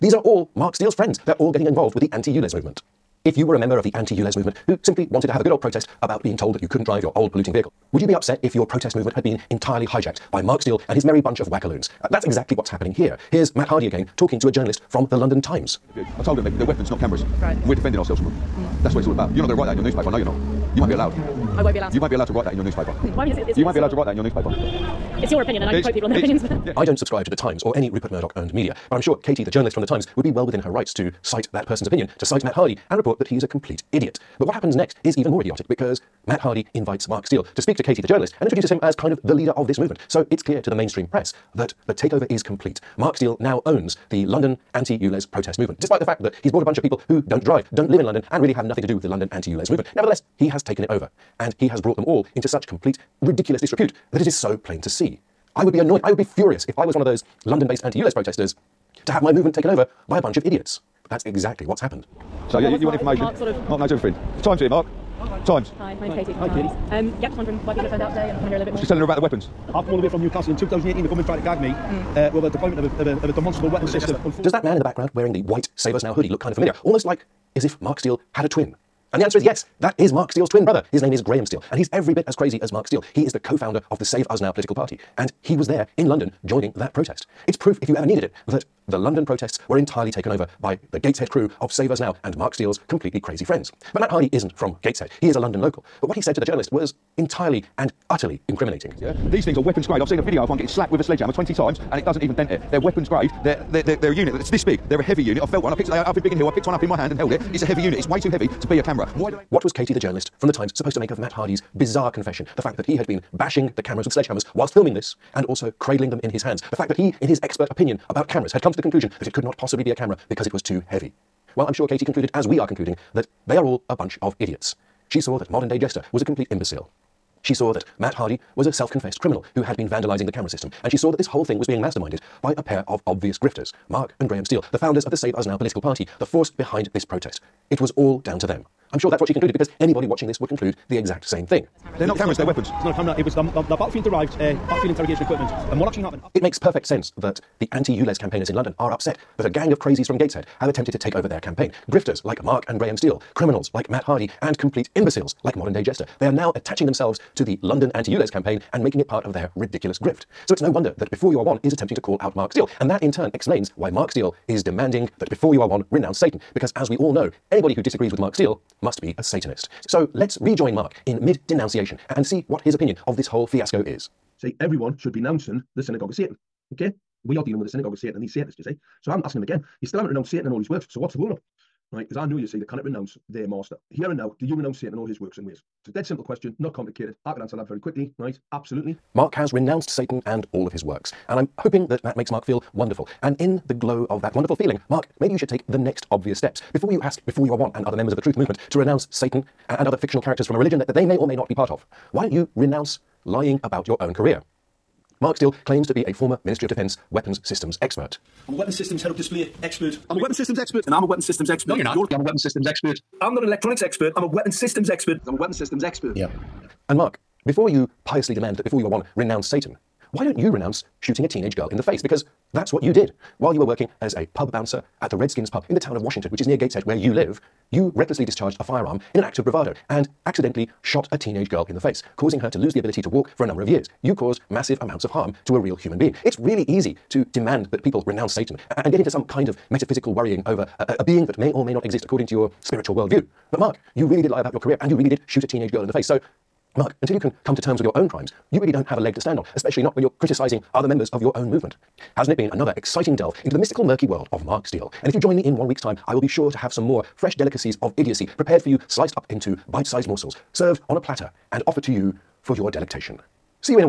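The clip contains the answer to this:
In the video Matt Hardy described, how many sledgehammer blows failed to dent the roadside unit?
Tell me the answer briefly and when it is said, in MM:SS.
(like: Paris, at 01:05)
20, at 01:41.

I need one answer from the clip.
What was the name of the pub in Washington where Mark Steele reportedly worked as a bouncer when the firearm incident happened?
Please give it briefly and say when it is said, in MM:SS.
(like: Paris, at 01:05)
Redskins pub, at 03:45.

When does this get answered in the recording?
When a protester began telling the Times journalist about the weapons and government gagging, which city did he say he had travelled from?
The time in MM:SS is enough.
01:10.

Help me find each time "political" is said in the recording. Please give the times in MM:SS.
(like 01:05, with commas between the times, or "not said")
01:24, 02:15.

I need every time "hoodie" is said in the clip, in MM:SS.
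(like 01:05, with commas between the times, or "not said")
01:16.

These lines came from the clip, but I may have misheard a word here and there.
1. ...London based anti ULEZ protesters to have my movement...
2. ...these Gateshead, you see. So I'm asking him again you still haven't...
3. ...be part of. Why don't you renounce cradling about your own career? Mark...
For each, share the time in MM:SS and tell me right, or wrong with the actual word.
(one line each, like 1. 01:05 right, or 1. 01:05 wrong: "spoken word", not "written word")
1. 00:57 right
2. 02:58 wrong: "Satanists", not "Gateshead"
3. 03:21 wrong: "lying", not "cradling".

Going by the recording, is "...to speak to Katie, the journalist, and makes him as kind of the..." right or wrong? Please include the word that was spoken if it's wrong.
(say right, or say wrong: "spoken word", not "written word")
wrong: "introduces", not "makes".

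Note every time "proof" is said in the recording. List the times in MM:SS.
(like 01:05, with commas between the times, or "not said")
01:27.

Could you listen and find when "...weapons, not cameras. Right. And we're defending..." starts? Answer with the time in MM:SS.
00:16.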